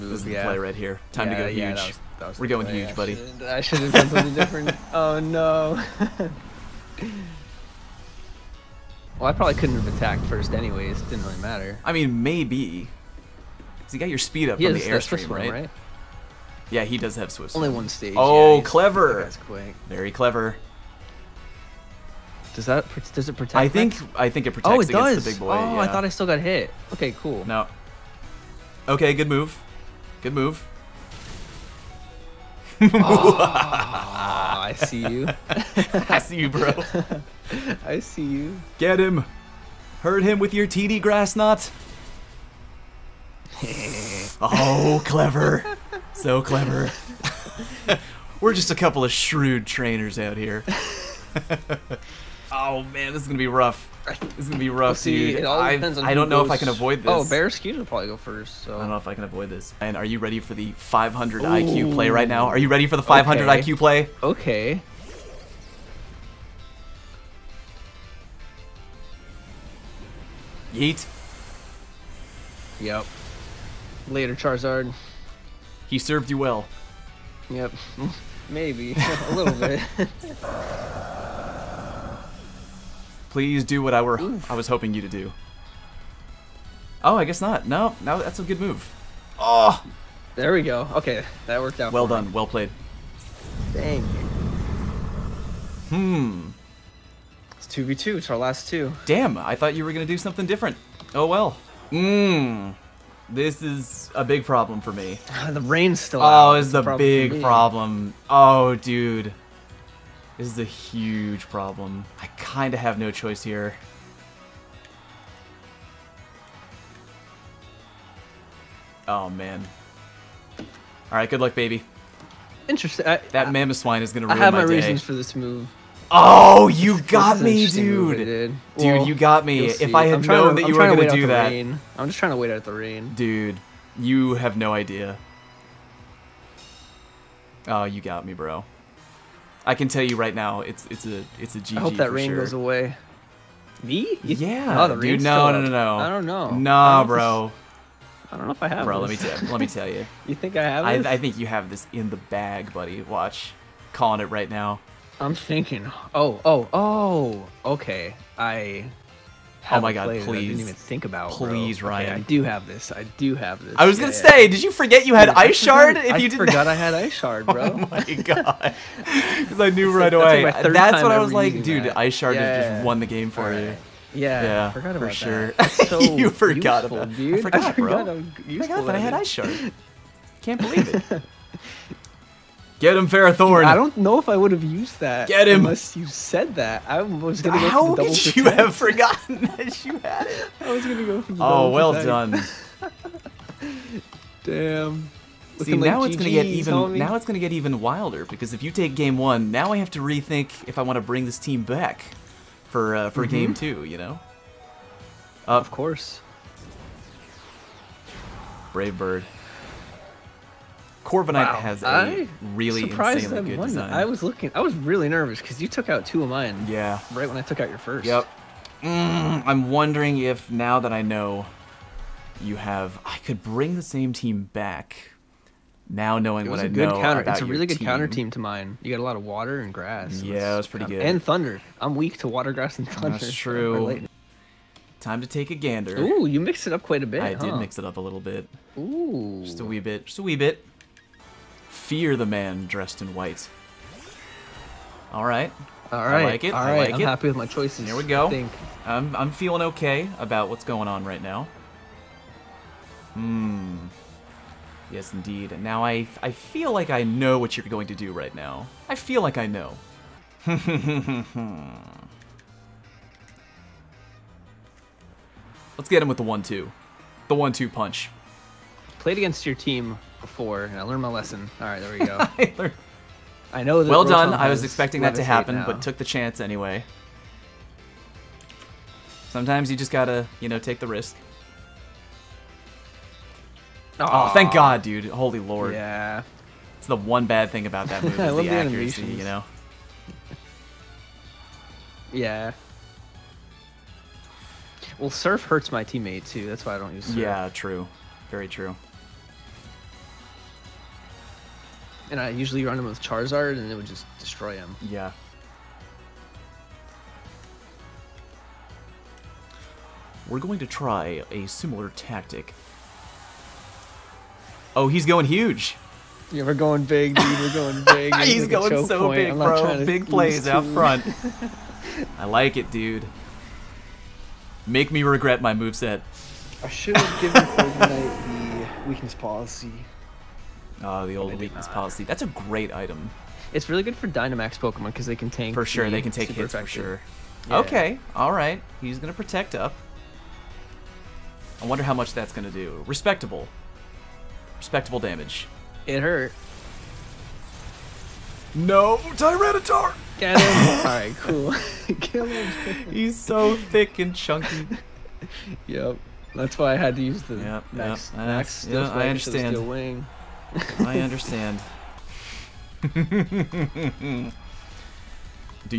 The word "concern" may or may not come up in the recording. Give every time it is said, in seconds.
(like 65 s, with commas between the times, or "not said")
not said.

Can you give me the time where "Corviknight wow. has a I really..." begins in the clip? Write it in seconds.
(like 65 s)
211 s.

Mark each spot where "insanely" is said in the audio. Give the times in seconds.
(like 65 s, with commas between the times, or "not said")
212 s.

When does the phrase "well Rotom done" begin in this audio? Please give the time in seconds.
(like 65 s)
273 s.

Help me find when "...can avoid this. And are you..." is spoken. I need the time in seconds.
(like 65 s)
59 s.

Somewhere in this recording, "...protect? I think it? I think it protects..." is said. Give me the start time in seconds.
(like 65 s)
23 s.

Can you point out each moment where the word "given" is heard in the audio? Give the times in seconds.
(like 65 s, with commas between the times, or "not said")
327 s.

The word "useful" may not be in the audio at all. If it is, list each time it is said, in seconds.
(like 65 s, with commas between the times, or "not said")
176 s.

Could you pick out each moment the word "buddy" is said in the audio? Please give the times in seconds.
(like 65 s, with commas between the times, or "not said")
2 s, 152 s.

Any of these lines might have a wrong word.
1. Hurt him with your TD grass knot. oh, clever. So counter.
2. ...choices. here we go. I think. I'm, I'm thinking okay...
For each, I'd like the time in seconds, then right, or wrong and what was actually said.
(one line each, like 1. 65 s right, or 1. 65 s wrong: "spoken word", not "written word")
1. 40 s wrong: "clever", not "counter"
2. 247 s wrong: "feeling", not "thinking".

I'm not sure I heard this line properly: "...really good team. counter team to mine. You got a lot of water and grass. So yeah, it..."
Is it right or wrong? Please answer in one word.
right.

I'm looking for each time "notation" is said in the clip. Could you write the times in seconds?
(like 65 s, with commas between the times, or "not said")
not said.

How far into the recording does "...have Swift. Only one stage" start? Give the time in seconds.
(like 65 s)
17 s.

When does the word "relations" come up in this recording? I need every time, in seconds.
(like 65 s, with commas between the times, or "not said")
not said.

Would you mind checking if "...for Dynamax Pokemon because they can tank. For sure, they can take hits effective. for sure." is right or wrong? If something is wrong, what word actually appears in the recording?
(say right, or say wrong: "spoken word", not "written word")
right.